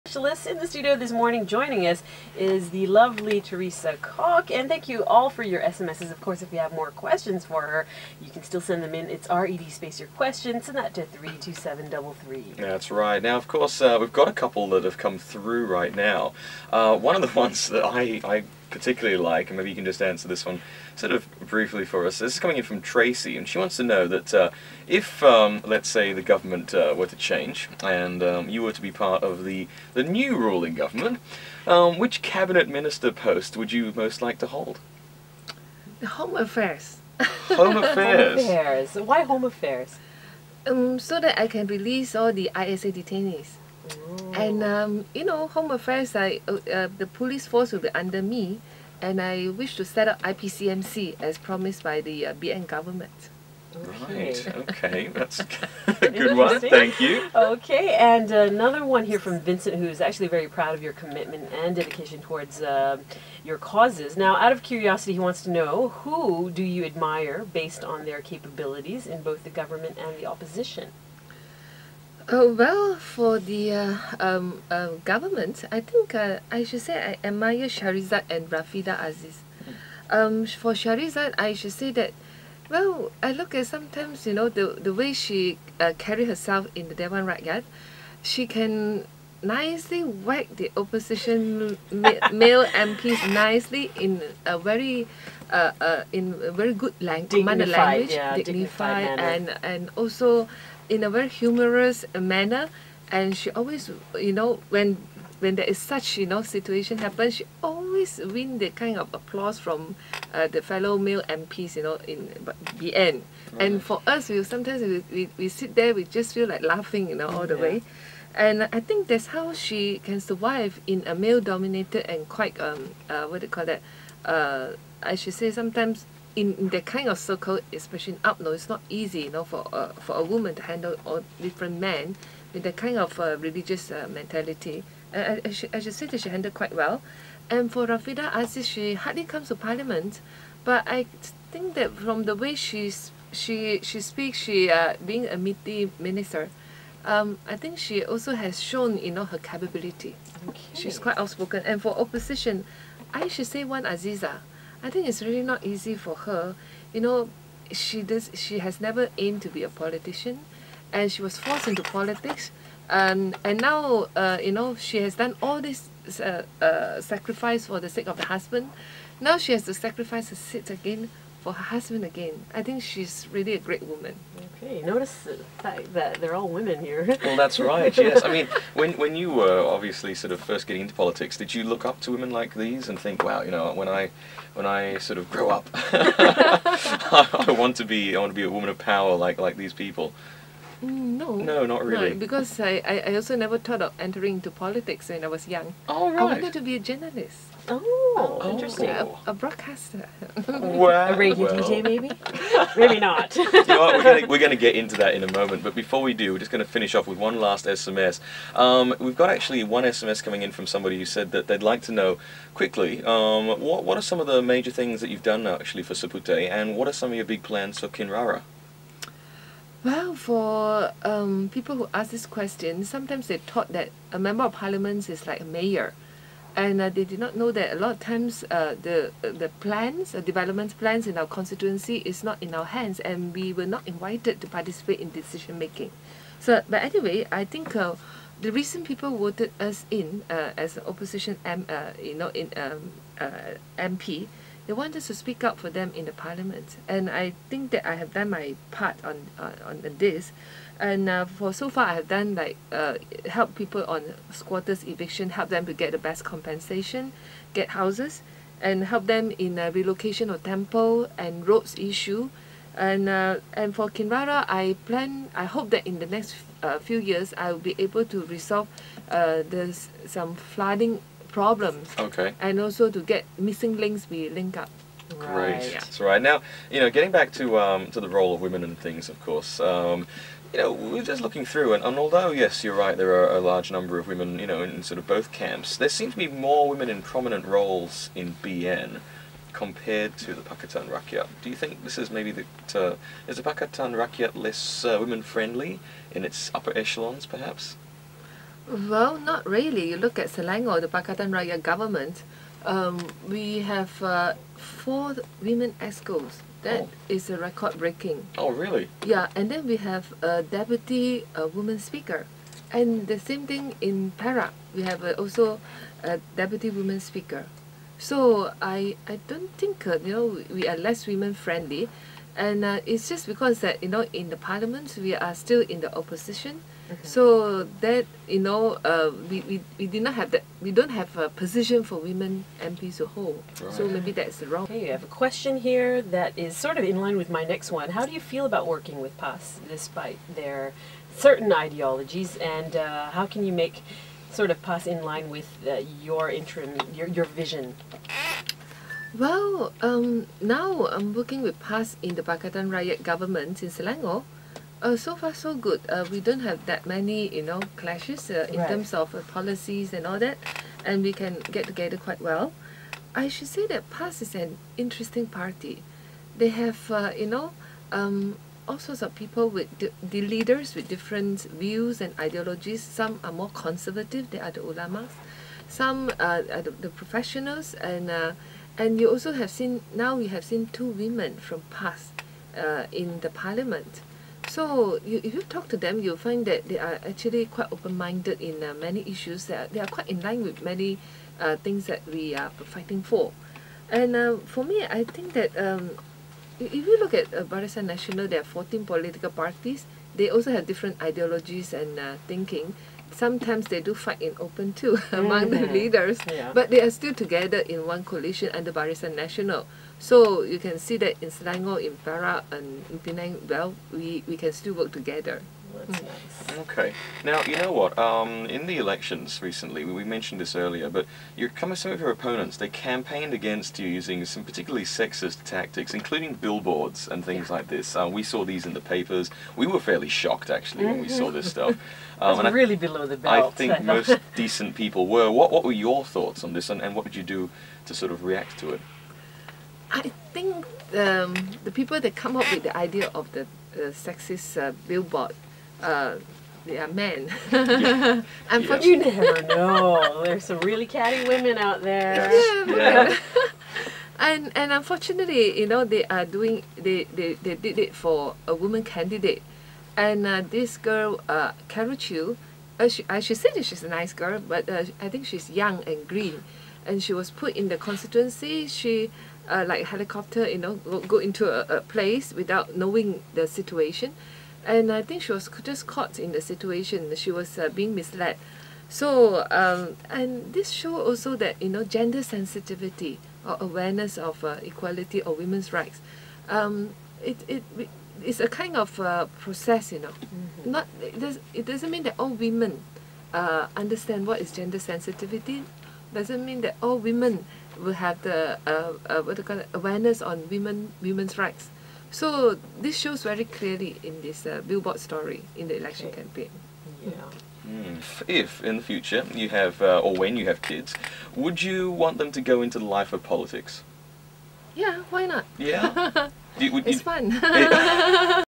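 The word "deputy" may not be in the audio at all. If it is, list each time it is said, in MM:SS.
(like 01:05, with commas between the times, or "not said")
05:10, 05:16.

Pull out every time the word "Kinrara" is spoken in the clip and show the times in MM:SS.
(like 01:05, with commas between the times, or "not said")
03:37, 04:23.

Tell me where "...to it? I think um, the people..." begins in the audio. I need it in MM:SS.
07:18.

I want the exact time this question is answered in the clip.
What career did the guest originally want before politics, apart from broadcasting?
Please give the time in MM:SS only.
03:16.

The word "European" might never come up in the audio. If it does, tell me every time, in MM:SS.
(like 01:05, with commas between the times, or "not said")
not said.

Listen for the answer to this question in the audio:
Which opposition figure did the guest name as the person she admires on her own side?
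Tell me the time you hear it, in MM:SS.
02:33.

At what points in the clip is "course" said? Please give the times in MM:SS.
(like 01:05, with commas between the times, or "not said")
00:06, 00:13, 04:39.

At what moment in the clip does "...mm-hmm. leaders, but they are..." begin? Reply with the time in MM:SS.
06:45.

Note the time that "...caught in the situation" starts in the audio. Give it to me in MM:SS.
07:55.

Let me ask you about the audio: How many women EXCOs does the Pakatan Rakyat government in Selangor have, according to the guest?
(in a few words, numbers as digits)
4.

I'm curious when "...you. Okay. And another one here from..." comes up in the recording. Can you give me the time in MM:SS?
00:56.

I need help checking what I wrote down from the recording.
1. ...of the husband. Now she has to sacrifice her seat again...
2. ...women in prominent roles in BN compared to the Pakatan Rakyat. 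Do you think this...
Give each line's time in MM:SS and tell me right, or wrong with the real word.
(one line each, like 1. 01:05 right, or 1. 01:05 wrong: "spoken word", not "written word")
1. 02:48 right
2. 04:46 right.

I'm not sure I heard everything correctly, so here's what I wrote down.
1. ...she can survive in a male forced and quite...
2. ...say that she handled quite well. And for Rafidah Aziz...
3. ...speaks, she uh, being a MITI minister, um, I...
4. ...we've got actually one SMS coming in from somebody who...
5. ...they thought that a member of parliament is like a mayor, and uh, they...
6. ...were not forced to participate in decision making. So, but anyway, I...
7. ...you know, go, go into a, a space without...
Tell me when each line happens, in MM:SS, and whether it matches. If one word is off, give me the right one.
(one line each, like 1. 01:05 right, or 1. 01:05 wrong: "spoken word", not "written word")
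1. 01:59 wrong: "dominated", not "forced"
2. 02:15 right
3. 02:23 right
4. 03:28 right
5. 03:43 right
6. 03:53 wrong: "invited", not "forced"
7. 07:50 wrong: "place", not "space".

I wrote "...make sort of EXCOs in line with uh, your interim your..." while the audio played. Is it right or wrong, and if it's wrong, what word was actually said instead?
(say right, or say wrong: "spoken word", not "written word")
wrong: "PAS", not "EXCOs".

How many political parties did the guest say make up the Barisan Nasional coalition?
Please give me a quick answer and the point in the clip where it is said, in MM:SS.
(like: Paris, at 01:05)
14, at 06:38.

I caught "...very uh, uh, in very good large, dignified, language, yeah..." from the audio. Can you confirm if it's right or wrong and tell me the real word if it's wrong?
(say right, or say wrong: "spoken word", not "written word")
wrong: "language", not "large".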